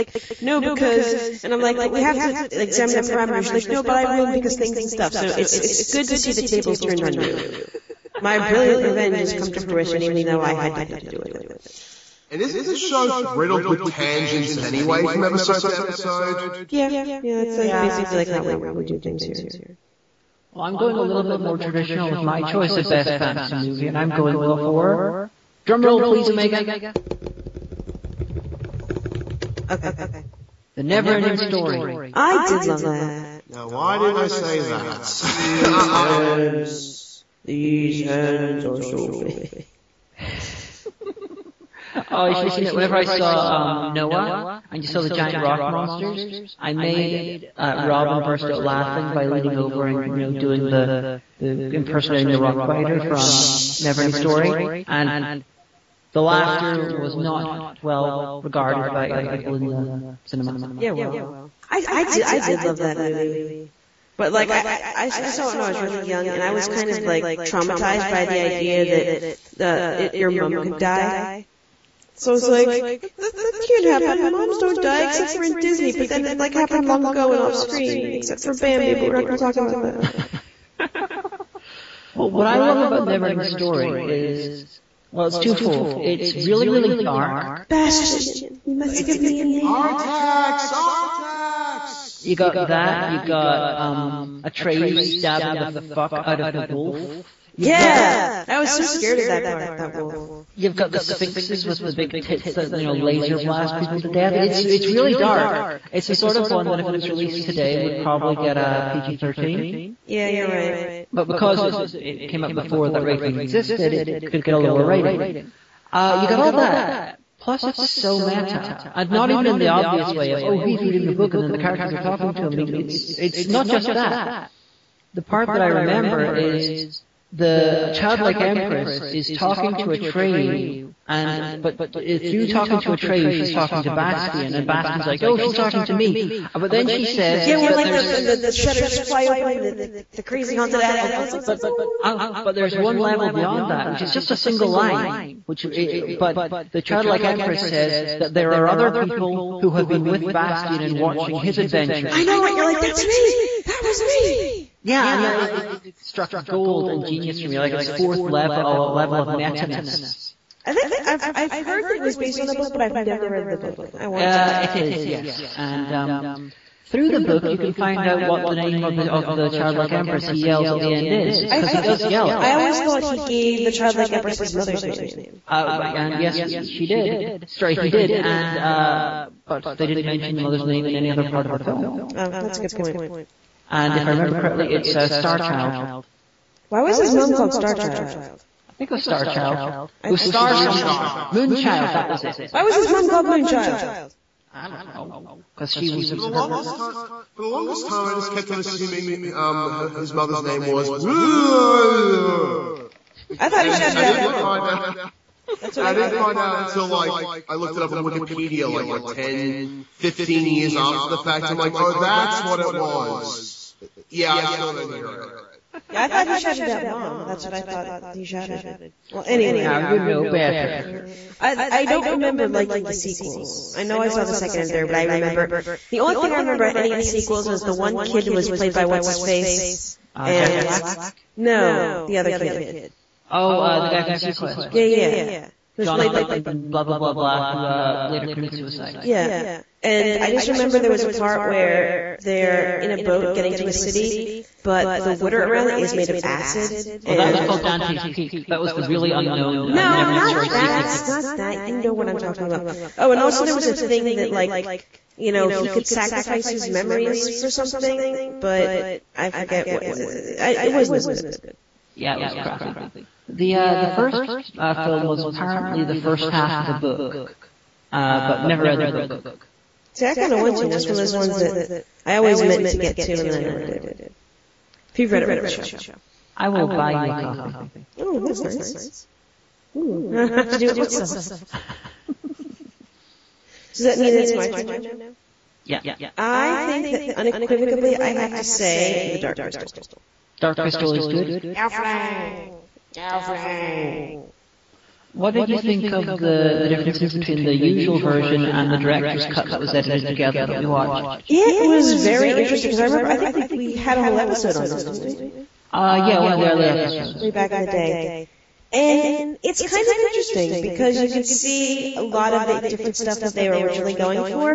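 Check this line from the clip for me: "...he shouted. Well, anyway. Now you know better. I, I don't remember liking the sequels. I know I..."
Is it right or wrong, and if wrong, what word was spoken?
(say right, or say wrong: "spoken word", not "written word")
right.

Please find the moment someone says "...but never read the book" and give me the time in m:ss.
4:28.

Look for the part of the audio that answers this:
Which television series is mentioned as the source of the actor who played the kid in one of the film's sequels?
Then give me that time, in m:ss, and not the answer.
3:54.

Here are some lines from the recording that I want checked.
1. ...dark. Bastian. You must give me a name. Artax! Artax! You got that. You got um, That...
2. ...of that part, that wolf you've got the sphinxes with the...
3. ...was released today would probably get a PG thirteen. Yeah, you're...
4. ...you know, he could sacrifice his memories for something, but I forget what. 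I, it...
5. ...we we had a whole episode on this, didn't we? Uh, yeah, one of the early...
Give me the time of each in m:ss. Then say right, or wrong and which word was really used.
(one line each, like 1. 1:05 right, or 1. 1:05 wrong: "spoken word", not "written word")
1. 1:26 wrong: "Atreyu", not "That"
2. 1:39 right
3. 1:46 right
4. 4:15 right
5. 5:03 right.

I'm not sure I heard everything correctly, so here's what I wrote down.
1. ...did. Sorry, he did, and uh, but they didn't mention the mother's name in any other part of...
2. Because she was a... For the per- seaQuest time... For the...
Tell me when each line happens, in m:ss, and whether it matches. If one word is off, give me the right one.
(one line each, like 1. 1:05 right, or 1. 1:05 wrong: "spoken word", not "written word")
1. 2:56 right
2. 3:15 wrong: "longest", not "seaQuest".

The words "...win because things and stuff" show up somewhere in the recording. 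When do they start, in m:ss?
0:04.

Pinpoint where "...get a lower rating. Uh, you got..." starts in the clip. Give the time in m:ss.
1:54.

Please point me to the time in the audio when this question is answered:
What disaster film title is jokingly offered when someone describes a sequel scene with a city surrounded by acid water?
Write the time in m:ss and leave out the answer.
4:07.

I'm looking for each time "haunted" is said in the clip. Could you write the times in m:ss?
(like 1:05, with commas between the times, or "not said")
2:20.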